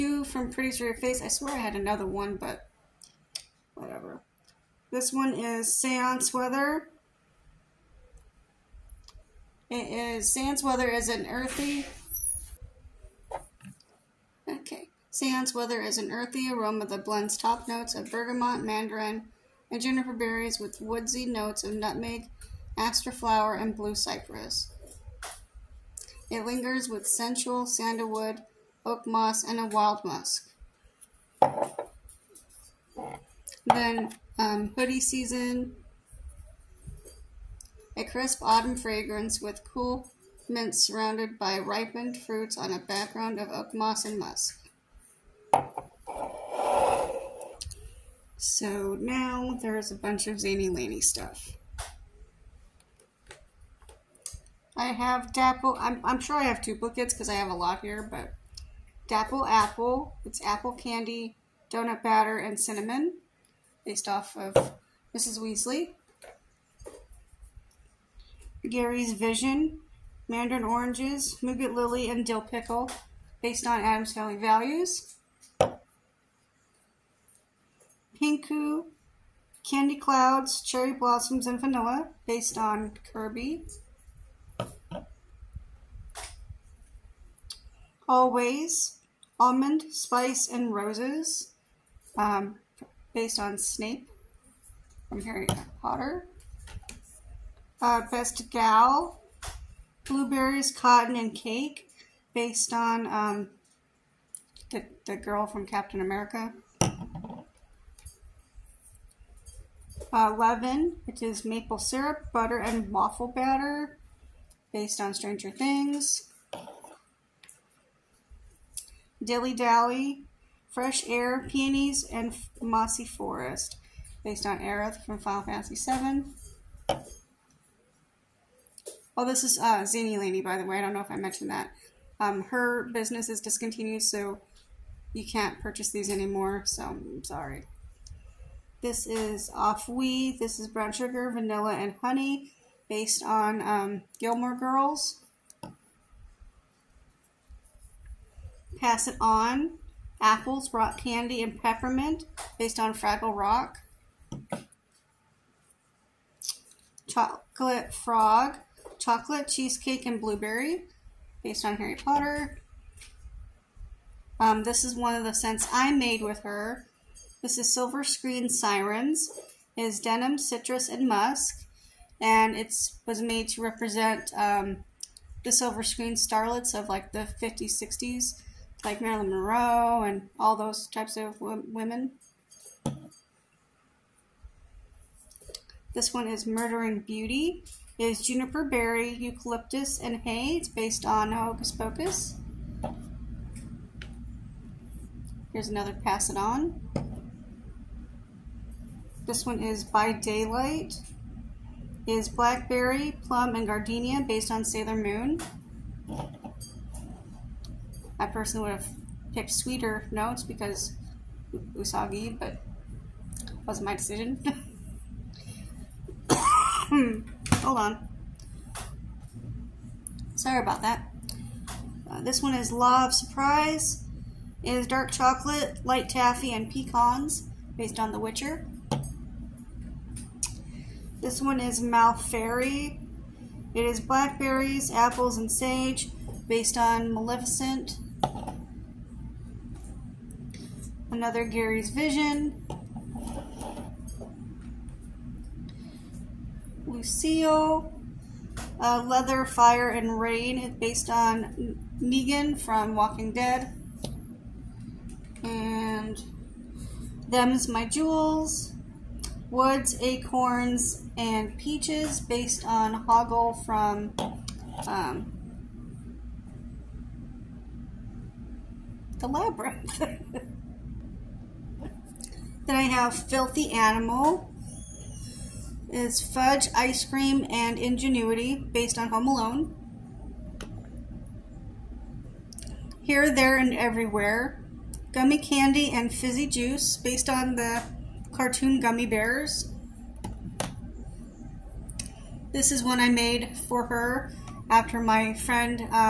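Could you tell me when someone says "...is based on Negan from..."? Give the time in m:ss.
4:10.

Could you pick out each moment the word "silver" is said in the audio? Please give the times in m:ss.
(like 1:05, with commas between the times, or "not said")
2:47, 2:55.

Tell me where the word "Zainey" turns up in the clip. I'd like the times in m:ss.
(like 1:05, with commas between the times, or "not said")
0:50, 2:09.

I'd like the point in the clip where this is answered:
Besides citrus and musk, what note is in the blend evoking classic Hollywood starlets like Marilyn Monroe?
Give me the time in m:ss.
2:49.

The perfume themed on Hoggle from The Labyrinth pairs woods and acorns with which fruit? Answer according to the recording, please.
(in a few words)
Peaches.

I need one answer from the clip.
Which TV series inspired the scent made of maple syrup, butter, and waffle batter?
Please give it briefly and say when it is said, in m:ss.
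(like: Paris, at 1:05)
Stranger Things, at 1:55.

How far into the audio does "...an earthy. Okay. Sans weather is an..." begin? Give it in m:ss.
0:11.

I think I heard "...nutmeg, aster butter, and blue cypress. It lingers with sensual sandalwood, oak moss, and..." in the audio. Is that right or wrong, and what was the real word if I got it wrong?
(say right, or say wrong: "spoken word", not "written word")
wrong: "flower", not "butter".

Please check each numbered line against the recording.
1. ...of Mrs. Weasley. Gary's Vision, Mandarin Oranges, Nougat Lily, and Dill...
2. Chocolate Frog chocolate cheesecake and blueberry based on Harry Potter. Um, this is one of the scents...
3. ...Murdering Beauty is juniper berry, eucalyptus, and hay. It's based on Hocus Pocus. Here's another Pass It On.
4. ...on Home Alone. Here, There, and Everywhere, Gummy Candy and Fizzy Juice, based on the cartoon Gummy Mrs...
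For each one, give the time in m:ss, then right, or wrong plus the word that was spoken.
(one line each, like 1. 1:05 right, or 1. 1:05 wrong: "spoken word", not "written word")
1. 1:04 right
2. 2:37 right
3. 3:06 right
4. 4:38 wrong: "Bears", not "Mrs".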